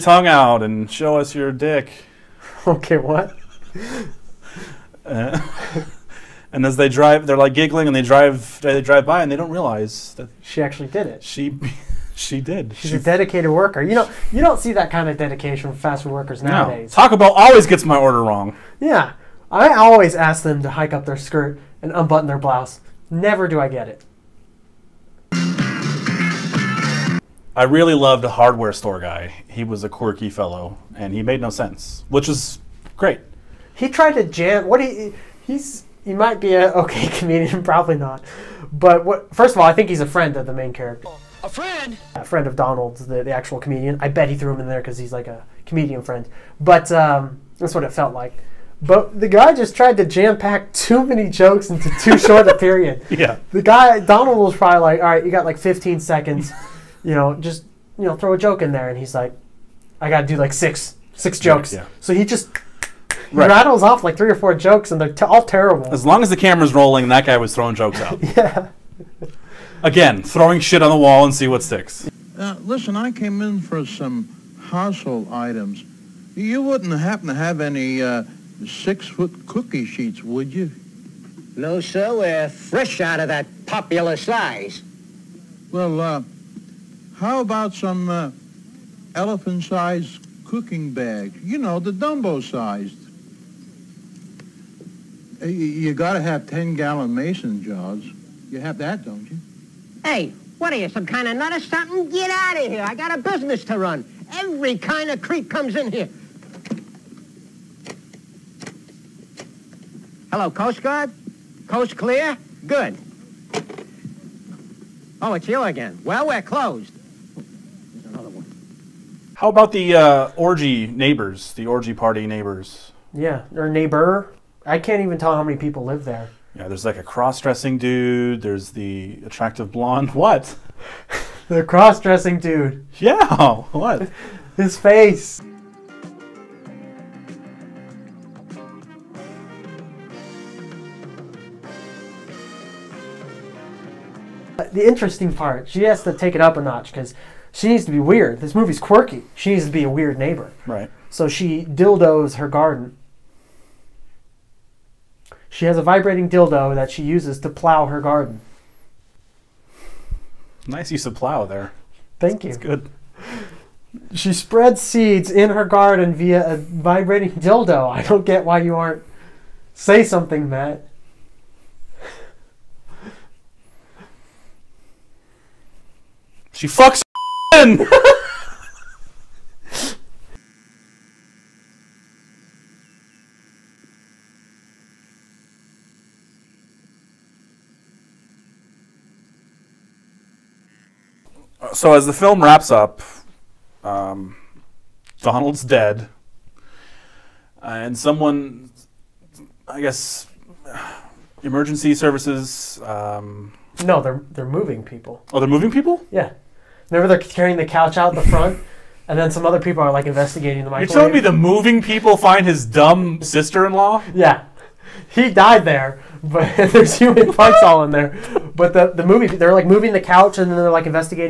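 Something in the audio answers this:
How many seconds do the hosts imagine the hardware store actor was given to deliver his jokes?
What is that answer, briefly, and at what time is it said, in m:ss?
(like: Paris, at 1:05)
15, at 0:55.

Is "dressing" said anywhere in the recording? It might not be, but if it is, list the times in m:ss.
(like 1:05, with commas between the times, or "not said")
2:07, 2:11.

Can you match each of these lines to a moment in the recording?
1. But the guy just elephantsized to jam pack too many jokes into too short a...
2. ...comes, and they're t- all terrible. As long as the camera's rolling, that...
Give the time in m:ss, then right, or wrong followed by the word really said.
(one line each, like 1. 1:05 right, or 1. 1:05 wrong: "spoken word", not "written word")
1. 0:48 wrong: "tried", not "elephantsized"
2. 1:04 wrong: "jokes", not "comes".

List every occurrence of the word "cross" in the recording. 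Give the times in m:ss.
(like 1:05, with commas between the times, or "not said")
2:07, 2:11.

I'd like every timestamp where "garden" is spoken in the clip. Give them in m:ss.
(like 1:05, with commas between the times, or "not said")
2:32, 2:38, 2:45.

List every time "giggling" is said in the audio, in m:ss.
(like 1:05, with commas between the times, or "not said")
0:07.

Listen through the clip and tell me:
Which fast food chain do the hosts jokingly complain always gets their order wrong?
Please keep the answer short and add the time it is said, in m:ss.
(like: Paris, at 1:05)
Taco Bell, at 0:17.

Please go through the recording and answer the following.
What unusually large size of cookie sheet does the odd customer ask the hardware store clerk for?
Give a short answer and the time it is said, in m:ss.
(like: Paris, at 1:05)
six-foot, at 1:18.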